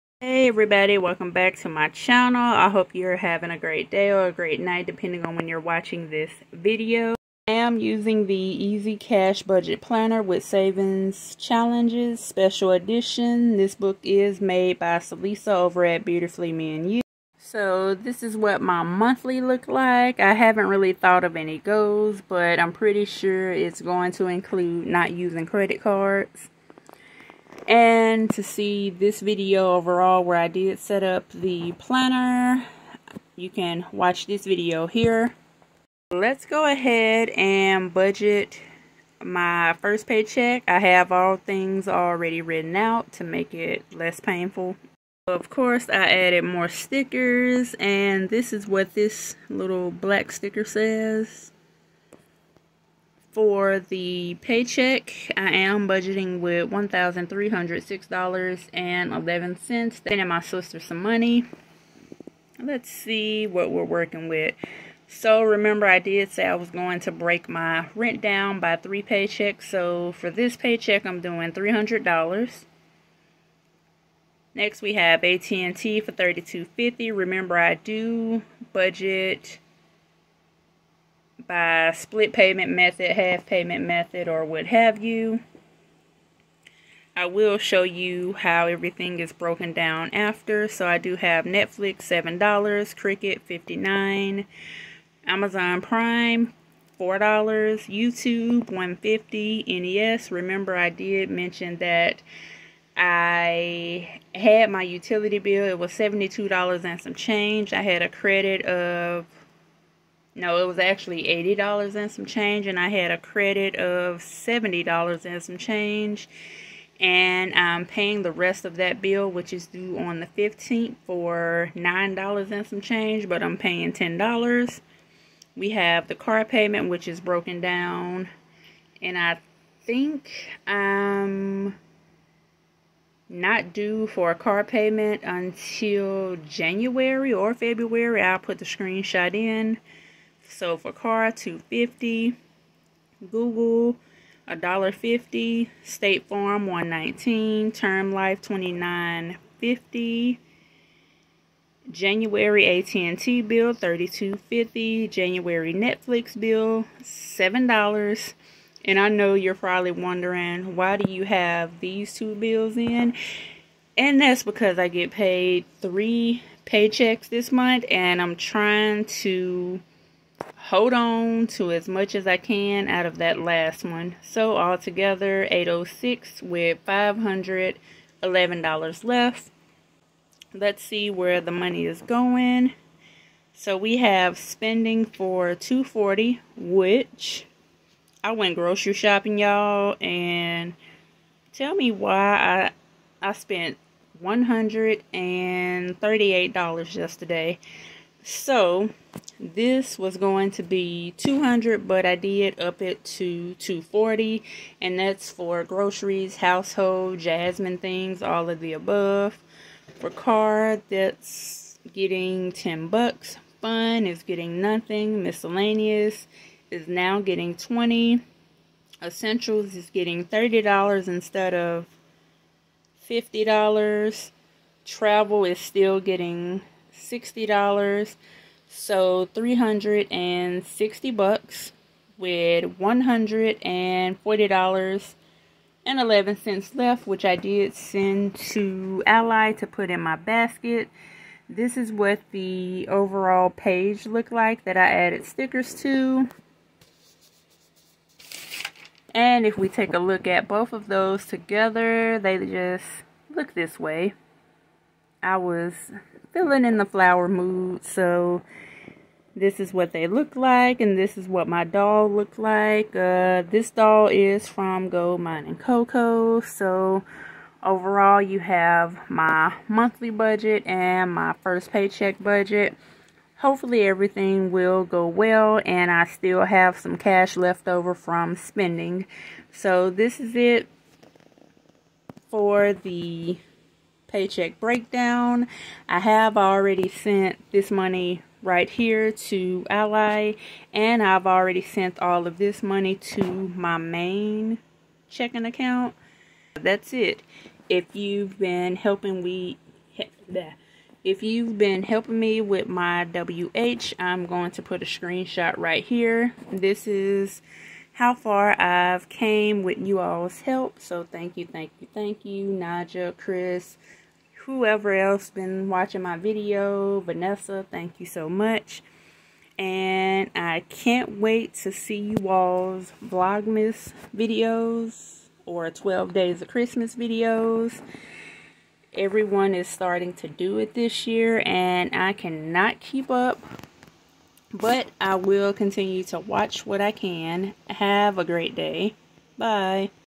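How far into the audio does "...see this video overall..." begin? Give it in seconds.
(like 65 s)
28 s.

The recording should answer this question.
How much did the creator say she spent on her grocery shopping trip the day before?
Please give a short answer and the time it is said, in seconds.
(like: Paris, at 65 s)
$138, at 194 s.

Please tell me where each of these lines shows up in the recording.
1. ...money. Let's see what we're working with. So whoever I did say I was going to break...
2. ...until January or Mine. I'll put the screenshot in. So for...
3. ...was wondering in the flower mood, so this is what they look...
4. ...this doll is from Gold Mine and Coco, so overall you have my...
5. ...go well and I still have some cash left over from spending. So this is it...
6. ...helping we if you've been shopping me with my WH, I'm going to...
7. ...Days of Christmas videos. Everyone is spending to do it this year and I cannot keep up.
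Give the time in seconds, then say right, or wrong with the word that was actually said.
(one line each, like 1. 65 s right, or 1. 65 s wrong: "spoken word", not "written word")
1. 61 s wrong: "remember", not "whoever"
2. 135 s wrong: "February", not "Mine"
3. 255 s wrong: "feeling", not "wondering"
4. 263 s right
5. 274 s right
6. 298 s wrong: "helping", not "shopping"
7. 326 s wrong: "starting", not "spending".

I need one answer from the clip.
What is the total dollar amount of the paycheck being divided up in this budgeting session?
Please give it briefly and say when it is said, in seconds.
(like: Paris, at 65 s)
$1,306.11, at 56 s.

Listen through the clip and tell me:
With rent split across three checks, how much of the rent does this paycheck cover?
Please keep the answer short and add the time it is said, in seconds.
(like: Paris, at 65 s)
$300, at 71 s.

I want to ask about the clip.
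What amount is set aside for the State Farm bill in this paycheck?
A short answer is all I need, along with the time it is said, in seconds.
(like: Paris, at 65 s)
$119, at 146 s.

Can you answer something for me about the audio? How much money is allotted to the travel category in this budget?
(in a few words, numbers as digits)
$60.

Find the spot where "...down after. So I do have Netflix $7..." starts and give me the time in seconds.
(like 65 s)
89 s.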